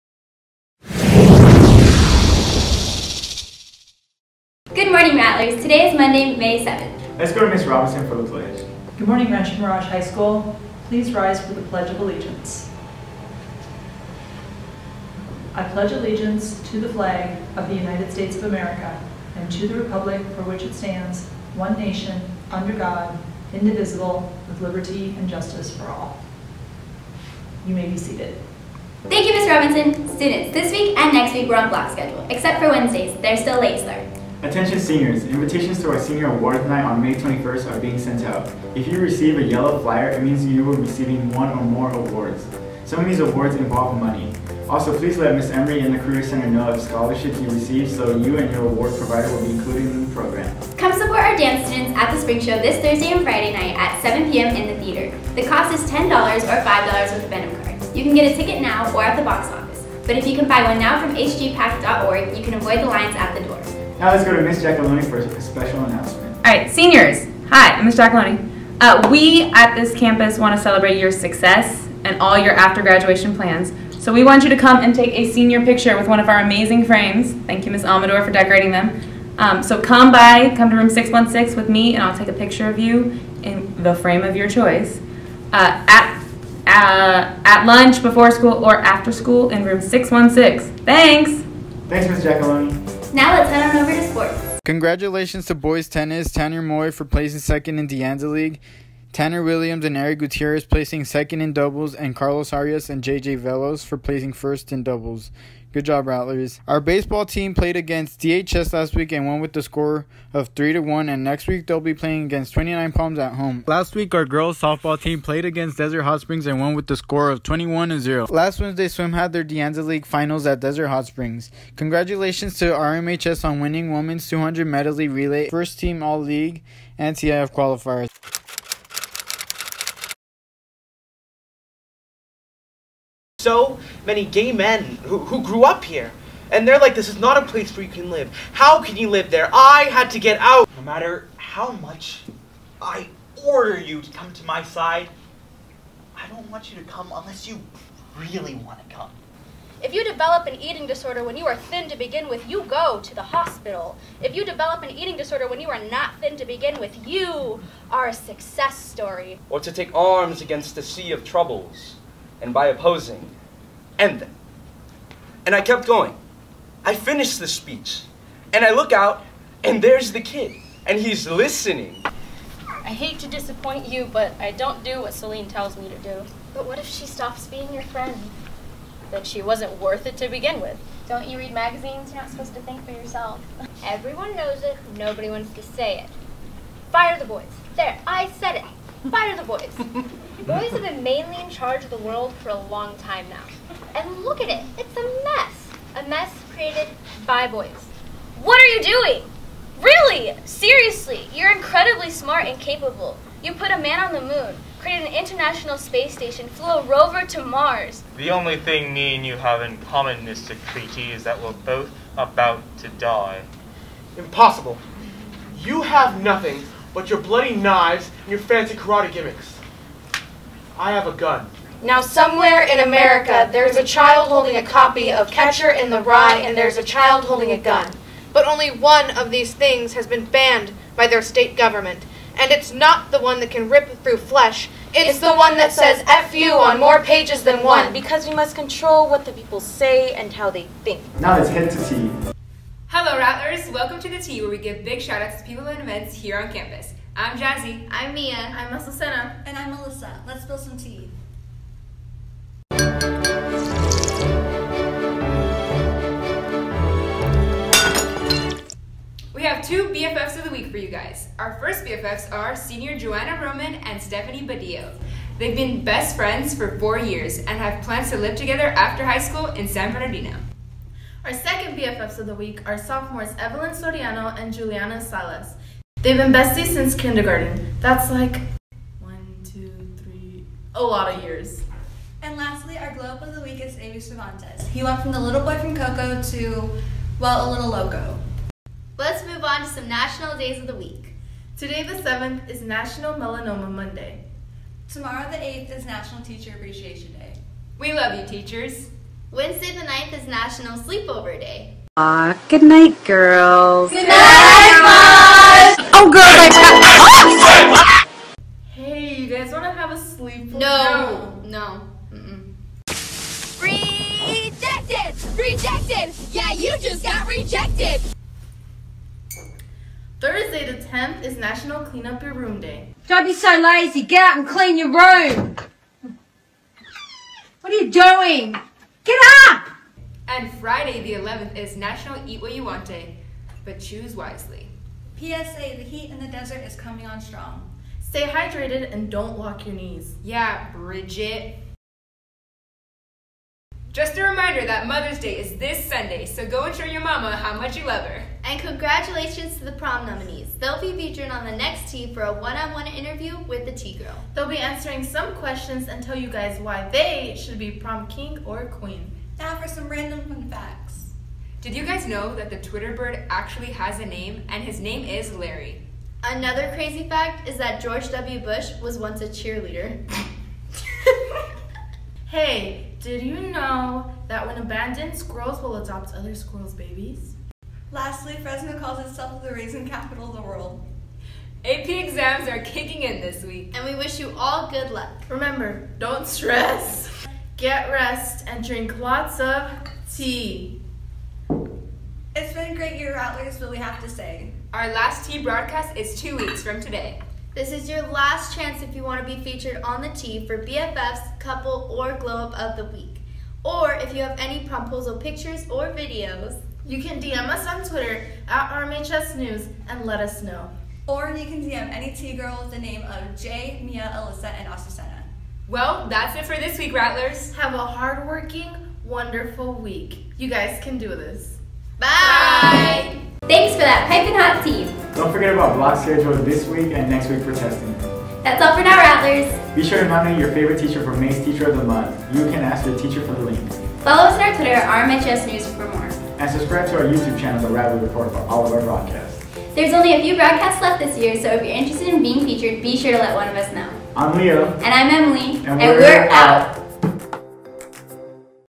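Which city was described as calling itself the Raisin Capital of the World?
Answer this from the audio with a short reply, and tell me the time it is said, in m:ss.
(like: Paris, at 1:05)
Fresno, at 6:18.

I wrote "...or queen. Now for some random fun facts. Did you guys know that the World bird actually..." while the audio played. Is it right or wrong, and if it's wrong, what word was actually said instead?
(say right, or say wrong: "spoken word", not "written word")
wrong: "Twitter", not "World".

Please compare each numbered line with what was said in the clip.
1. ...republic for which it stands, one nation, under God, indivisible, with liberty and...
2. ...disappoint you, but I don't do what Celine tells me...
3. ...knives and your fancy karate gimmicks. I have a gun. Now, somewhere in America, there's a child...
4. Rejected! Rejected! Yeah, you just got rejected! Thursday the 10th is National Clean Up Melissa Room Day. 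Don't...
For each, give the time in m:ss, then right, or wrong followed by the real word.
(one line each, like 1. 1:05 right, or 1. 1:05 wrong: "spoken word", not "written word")
1. 0:19 right
2. 2:53 right
3. 3:37 right
4. 5:13 wrong: "Your", not "Melissa".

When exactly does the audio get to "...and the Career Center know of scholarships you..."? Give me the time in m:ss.
0:45.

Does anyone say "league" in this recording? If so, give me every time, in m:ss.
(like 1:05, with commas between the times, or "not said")
1:38, 1:59, 2:06.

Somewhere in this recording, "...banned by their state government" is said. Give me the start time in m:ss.
3:50.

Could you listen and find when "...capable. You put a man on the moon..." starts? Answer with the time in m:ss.
3:22.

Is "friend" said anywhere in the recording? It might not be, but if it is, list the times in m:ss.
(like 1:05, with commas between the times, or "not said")
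2:57, 4:26.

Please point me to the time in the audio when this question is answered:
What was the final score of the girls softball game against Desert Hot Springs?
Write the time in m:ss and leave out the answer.
1:57.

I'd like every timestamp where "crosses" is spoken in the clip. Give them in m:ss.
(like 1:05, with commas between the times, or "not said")
not said.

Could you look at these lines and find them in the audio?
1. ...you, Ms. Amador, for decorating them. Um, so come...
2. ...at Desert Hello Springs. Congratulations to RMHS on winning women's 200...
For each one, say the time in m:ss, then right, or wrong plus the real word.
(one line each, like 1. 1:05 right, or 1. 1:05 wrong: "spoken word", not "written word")
1. 1:17 right
2. 2:00 wrong: "Hot", not "Hello".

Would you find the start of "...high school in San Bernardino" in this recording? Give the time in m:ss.
4:29.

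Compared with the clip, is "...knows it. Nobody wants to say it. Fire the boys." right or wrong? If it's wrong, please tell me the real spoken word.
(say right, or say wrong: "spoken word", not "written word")
right.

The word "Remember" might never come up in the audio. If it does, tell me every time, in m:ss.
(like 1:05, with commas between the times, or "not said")
6:25.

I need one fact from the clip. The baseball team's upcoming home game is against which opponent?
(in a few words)
29 Palms.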